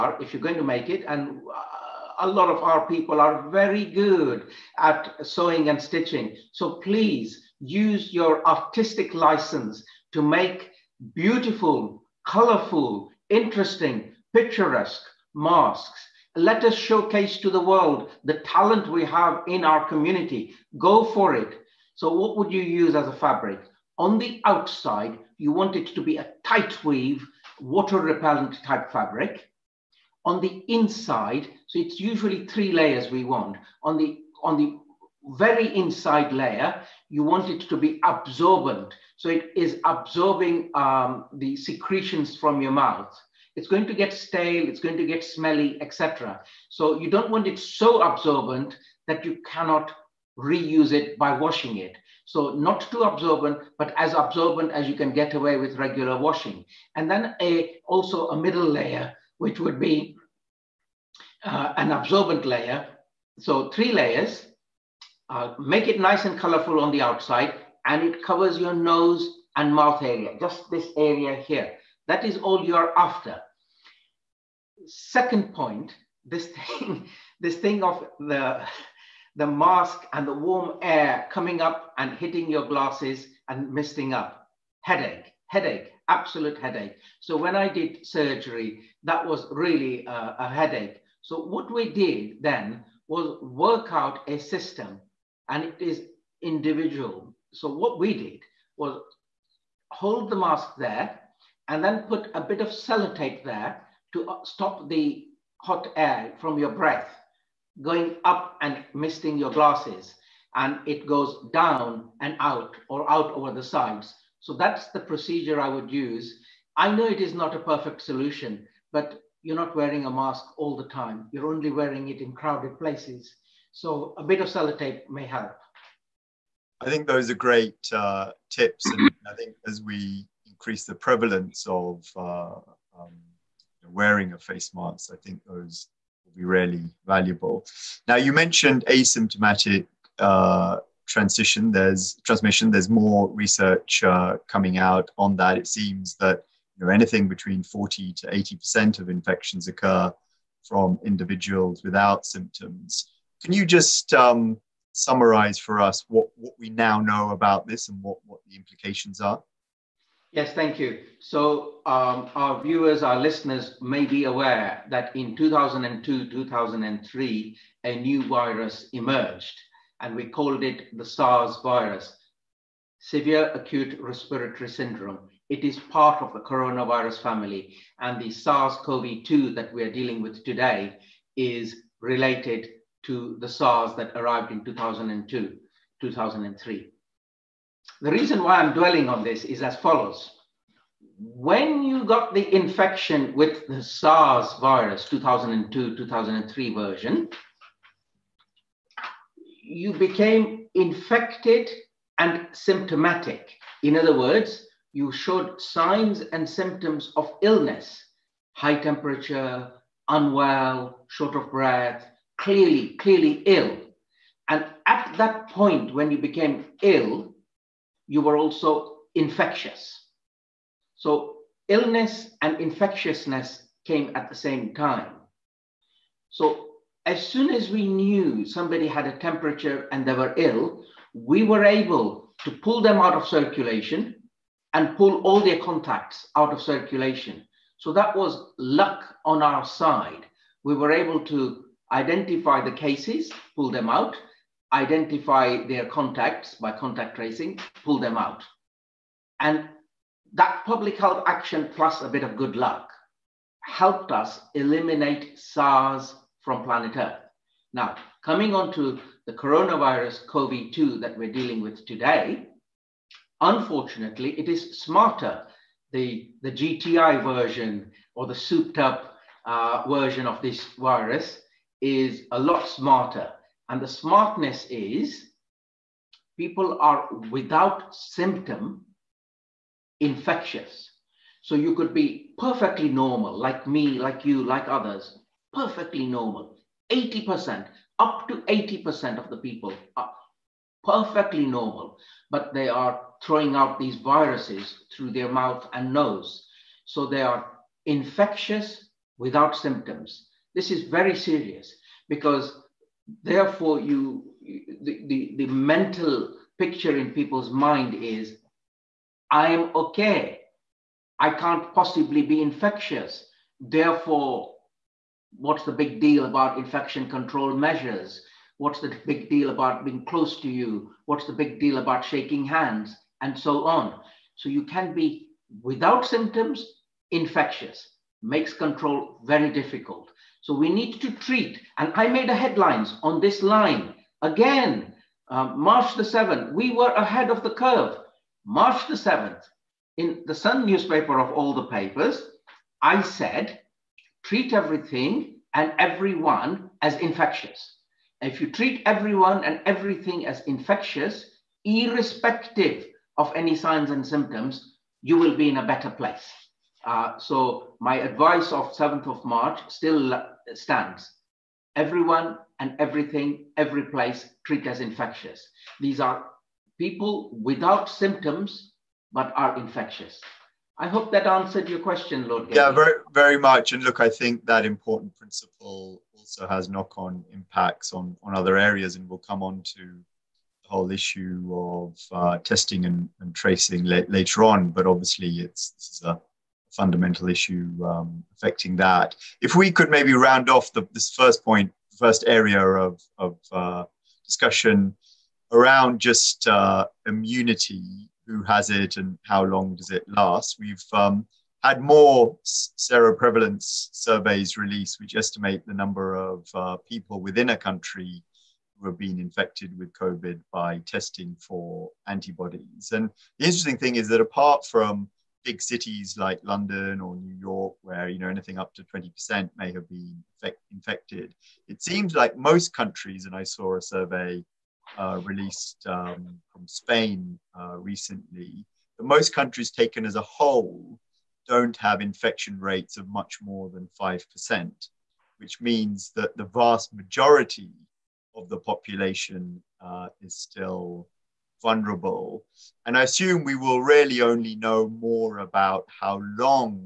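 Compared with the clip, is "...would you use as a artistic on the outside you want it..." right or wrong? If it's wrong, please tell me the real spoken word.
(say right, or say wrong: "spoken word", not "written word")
wrong: "fabric", not "artistic".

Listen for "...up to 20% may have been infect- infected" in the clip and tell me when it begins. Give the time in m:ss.
6:58.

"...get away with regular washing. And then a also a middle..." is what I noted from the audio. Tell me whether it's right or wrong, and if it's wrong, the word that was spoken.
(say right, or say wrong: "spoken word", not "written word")
right.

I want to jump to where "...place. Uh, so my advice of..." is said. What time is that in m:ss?
5:55.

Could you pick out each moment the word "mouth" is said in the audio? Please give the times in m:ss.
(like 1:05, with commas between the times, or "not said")
0:42, 1:09, 4:55.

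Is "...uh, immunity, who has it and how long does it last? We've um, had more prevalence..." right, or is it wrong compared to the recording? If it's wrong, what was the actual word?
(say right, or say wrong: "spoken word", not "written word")
wrong: "seroprevalence", not "prevalence".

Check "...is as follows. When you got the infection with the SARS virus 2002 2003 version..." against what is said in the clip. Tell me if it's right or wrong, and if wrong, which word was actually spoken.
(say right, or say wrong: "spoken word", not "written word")
right.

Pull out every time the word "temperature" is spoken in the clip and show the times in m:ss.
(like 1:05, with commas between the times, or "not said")
3:28, 3:49.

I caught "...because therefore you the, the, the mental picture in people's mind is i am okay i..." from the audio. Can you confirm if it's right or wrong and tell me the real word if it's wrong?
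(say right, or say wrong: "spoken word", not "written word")
right.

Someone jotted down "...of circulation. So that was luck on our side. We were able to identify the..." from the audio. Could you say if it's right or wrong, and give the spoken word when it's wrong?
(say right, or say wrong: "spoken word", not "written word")
right.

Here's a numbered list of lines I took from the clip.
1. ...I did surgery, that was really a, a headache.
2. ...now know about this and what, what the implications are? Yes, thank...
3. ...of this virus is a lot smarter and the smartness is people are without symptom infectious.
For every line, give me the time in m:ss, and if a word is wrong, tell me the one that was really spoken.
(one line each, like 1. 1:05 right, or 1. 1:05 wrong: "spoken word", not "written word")
1. 1:27 right
2. 2:36 right
3. 4:30 right.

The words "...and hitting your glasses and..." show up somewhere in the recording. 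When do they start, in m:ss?
1:21.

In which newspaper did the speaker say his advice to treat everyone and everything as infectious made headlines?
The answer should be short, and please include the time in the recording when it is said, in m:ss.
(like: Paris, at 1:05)
The Sun, at 5:40.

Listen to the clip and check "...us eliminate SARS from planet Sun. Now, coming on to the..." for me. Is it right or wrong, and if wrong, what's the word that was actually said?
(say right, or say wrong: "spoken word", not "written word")
wrong: "Earth", not "Sun".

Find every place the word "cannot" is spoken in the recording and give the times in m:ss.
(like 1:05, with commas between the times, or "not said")
0:49.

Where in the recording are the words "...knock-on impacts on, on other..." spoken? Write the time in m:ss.
6:16.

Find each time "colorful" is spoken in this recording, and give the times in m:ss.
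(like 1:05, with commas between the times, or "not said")
0:12, 1:06.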